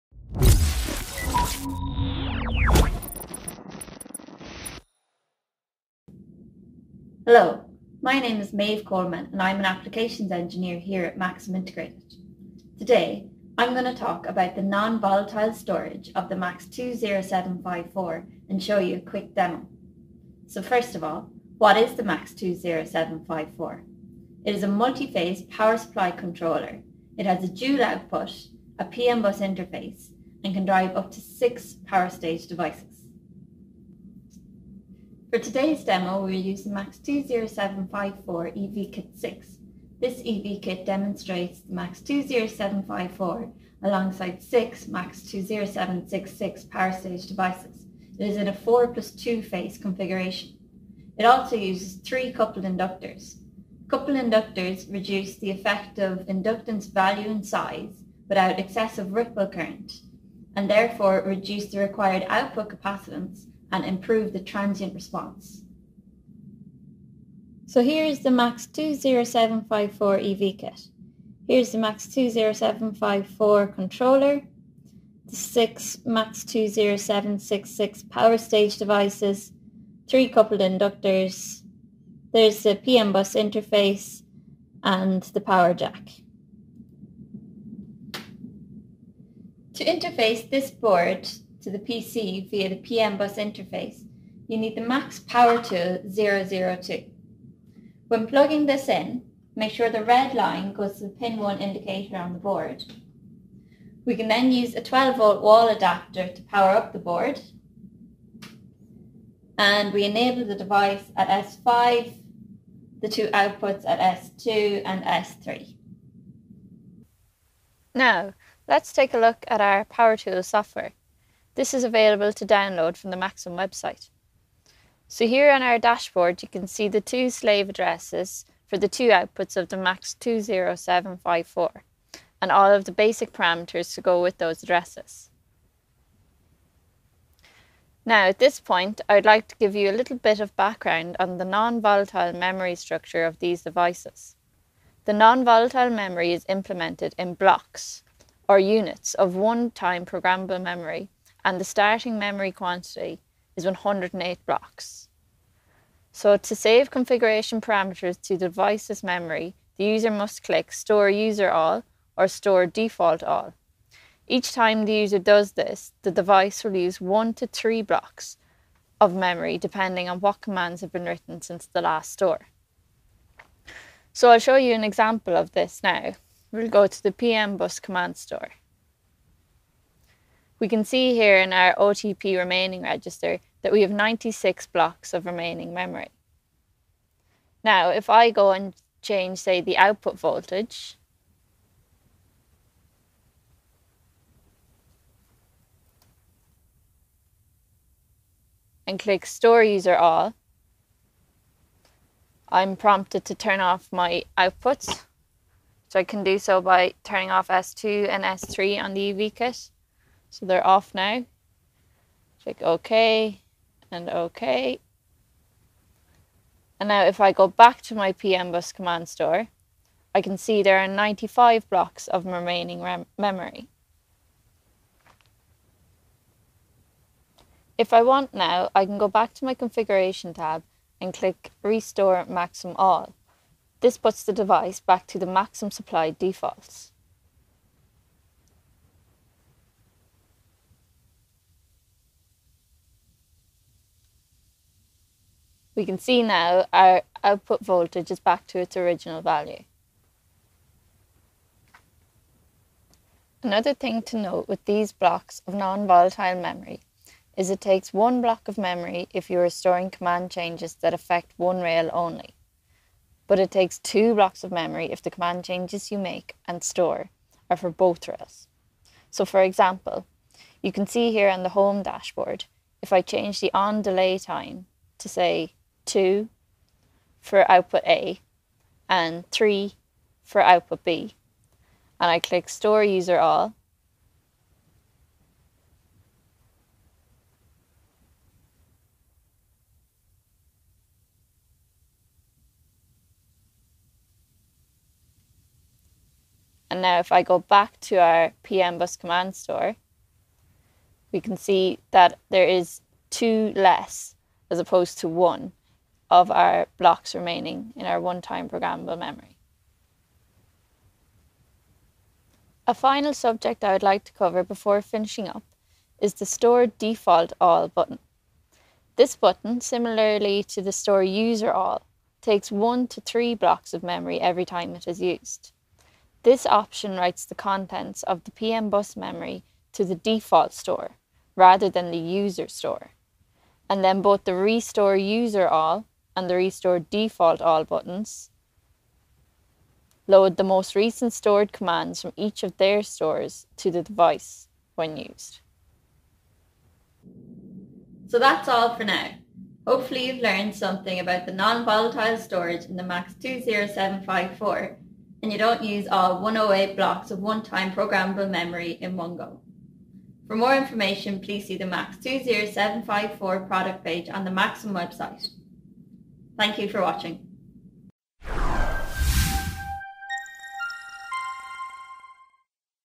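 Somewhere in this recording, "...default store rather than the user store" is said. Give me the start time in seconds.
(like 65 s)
329 s.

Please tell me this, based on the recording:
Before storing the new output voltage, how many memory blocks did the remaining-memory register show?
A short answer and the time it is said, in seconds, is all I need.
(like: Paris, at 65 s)
96, at 183 s.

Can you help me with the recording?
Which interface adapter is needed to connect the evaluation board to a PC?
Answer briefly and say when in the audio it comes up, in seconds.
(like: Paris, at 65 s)
Max Power Tool 002, at 94 s.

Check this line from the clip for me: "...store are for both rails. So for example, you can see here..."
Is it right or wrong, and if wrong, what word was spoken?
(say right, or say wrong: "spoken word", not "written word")
right.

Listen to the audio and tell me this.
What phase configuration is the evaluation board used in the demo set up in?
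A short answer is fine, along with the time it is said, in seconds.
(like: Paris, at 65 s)
4 plus 2, at 48 s.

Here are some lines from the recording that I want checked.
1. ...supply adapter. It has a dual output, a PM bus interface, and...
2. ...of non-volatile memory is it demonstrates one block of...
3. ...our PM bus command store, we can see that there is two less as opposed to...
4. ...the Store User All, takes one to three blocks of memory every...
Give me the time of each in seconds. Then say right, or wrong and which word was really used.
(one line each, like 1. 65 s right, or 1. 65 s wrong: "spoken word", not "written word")
1. 25 s wrong: "controller", not "adapter"
2. 255 s wrong: "takes", not "demonstrates"
3. 297 s right
4. 320 s right.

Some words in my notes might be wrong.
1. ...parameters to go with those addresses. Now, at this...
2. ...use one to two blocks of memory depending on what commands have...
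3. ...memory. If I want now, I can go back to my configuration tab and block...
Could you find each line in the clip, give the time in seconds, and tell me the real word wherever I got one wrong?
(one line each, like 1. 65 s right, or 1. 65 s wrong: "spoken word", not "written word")
1. 133 s right
2. 166 s wrong: "three", not "two"
3. 223 s wrong: "click", not "block".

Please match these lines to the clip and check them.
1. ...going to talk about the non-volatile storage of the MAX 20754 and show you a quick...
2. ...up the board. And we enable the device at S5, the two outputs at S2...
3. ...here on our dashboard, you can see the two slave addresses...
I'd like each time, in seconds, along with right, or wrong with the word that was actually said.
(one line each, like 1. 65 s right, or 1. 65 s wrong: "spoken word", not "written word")
1. 13 s right
2. 106 s right
3. 125 s right.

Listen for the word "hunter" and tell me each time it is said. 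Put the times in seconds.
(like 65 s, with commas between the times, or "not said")
not said.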